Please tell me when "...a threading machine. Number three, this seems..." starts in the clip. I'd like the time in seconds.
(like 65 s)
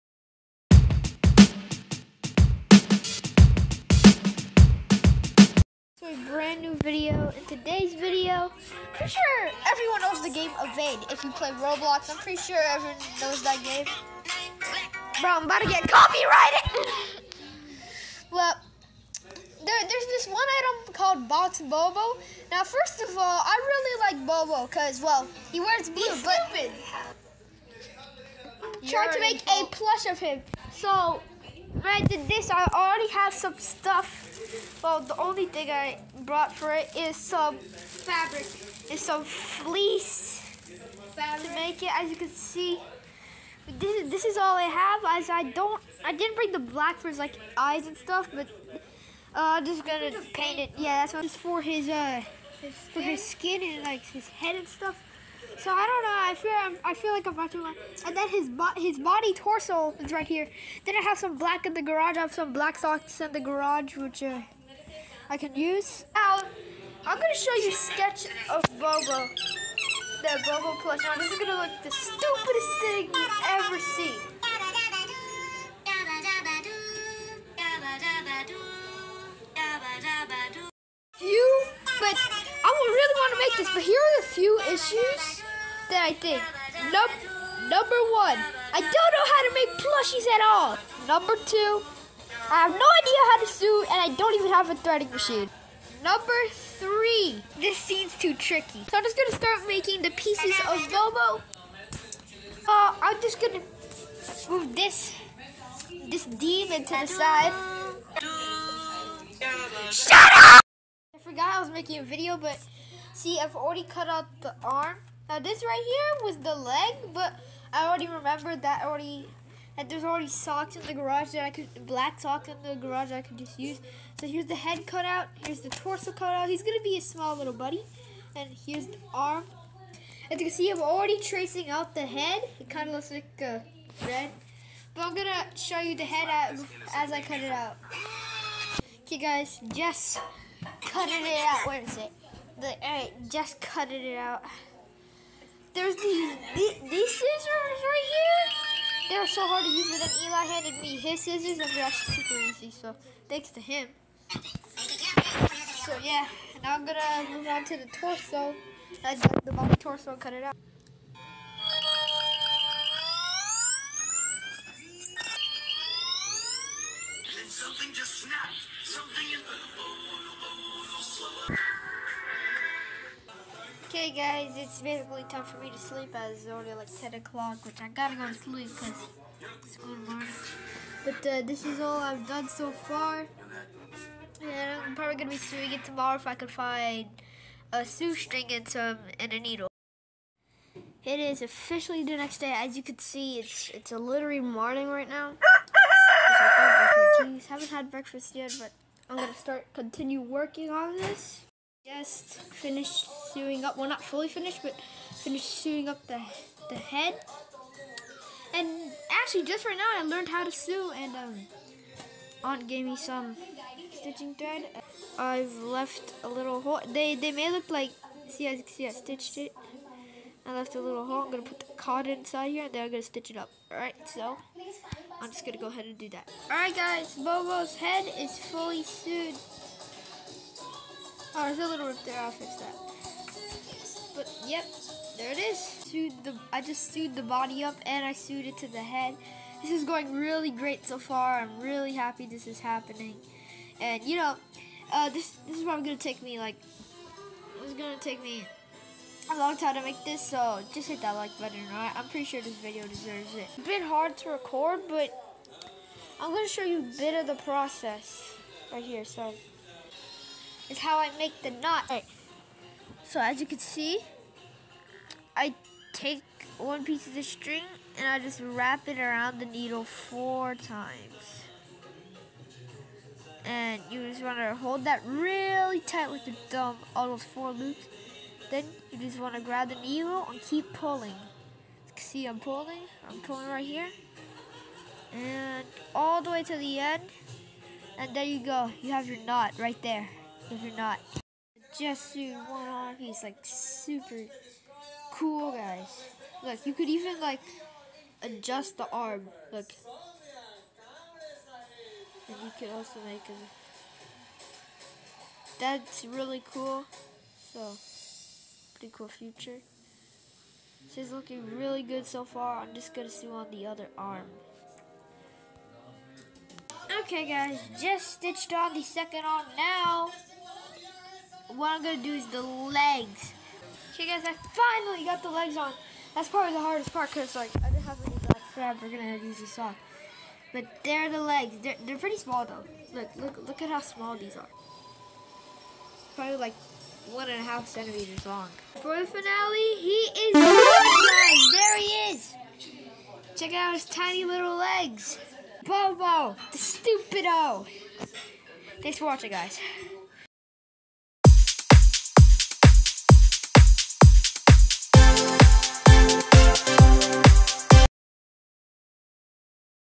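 94 s.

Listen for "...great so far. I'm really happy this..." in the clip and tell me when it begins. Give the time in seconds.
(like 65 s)
240 s.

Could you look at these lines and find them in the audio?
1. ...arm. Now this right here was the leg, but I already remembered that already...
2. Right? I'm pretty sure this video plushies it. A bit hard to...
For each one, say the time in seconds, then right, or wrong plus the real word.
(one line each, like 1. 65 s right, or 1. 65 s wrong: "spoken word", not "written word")
1. 114 s right
2. 251 s wrong: "deserves", not "plushies".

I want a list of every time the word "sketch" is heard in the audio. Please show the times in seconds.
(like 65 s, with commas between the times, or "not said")
67 s.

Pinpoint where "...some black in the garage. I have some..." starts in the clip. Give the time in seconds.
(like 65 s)
61 s.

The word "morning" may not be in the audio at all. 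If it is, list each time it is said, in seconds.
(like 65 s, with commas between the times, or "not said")
194 s.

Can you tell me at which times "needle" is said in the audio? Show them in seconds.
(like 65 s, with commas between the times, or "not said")
189 s, 269 s, 279 s.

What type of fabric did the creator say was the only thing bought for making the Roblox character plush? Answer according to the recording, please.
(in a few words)
Fleece fabric.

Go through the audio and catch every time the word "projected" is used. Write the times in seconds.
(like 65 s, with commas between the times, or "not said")
not said.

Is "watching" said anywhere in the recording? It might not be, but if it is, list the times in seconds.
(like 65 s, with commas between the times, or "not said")
57 s, 349 s.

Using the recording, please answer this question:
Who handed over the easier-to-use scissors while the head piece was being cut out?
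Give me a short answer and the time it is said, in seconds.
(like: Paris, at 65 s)
Eli, at 150 s.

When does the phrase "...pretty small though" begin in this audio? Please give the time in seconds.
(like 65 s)
331 s.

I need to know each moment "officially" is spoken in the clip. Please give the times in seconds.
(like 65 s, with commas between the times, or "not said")
191 s.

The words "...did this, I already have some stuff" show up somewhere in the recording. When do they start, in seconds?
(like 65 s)
32 s.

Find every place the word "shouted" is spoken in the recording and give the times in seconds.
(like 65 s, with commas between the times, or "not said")
not said.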